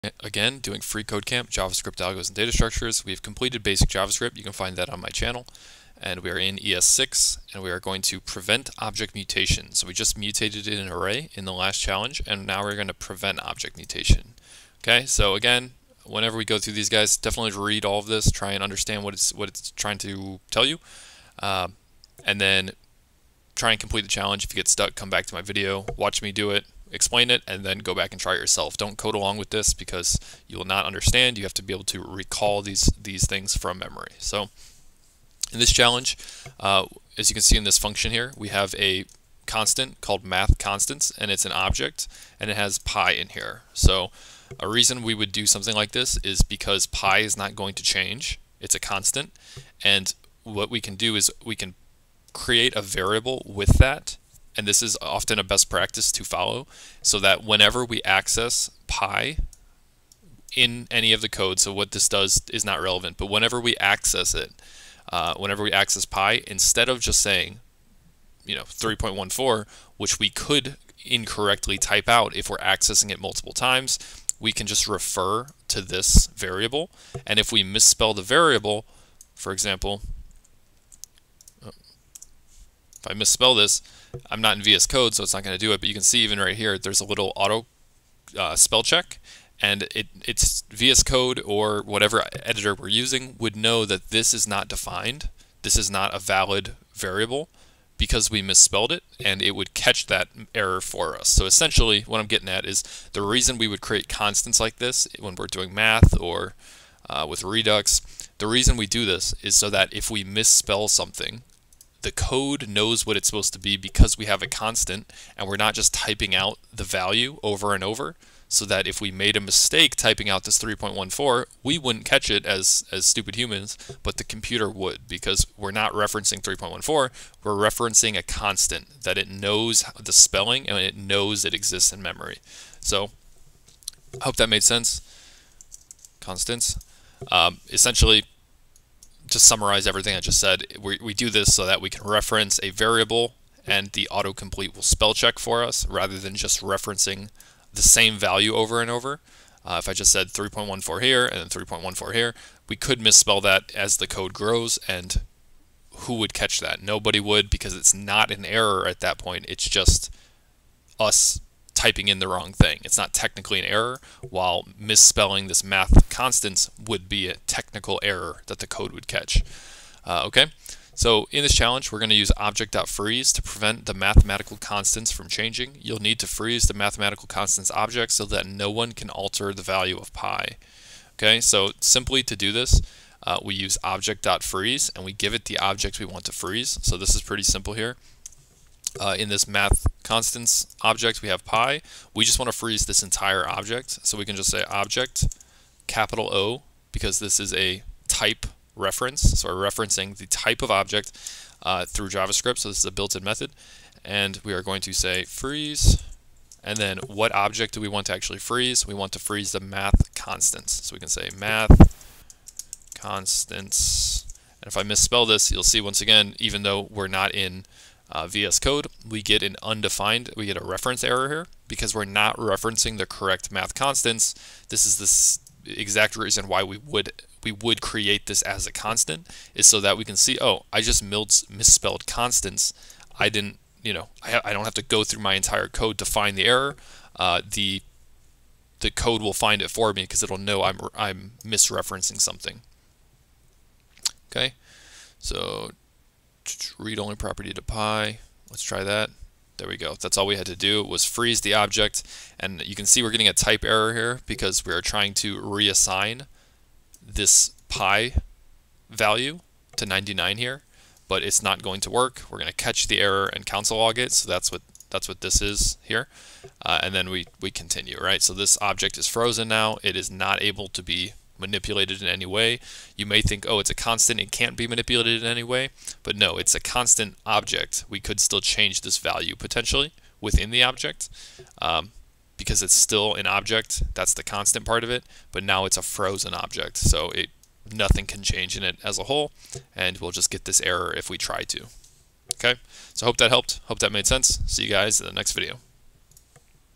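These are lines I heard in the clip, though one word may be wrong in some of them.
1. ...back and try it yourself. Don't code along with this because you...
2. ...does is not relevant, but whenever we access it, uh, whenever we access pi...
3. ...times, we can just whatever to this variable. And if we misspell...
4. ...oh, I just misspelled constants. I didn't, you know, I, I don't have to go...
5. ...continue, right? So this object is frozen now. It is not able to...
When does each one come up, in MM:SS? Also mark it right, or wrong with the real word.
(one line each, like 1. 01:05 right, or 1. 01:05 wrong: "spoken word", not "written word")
1. 00:27 right
2. 01:02 right
3. 01:13 wrong: "refer", not "whatever"
4. 03:50 right
5. 04:27 right.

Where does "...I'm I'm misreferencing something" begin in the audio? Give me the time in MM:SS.
04:00.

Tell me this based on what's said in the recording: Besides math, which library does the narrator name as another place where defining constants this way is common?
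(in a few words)
Redux.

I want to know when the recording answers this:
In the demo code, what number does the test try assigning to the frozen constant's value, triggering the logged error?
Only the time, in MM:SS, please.
04:19.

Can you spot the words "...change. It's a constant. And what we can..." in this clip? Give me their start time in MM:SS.
00:47.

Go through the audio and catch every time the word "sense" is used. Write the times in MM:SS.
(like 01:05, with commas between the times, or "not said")
02:14, 04:54.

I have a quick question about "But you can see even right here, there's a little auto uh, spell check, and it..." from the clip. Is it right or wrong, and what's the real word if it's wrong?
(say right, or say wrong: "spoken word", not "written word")
right.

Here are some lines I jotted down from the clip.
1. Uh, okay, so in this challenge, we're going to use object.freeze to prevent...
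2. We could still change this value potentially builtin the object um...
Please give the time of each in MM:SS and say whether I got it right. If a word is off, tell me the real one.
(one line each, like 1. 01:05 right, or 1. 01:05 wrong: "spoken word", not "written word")
1. 02:50 right
2. 04:37 wrong: "within", not "builtin".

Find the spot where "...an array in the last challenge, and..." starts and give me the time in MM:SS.
00:10.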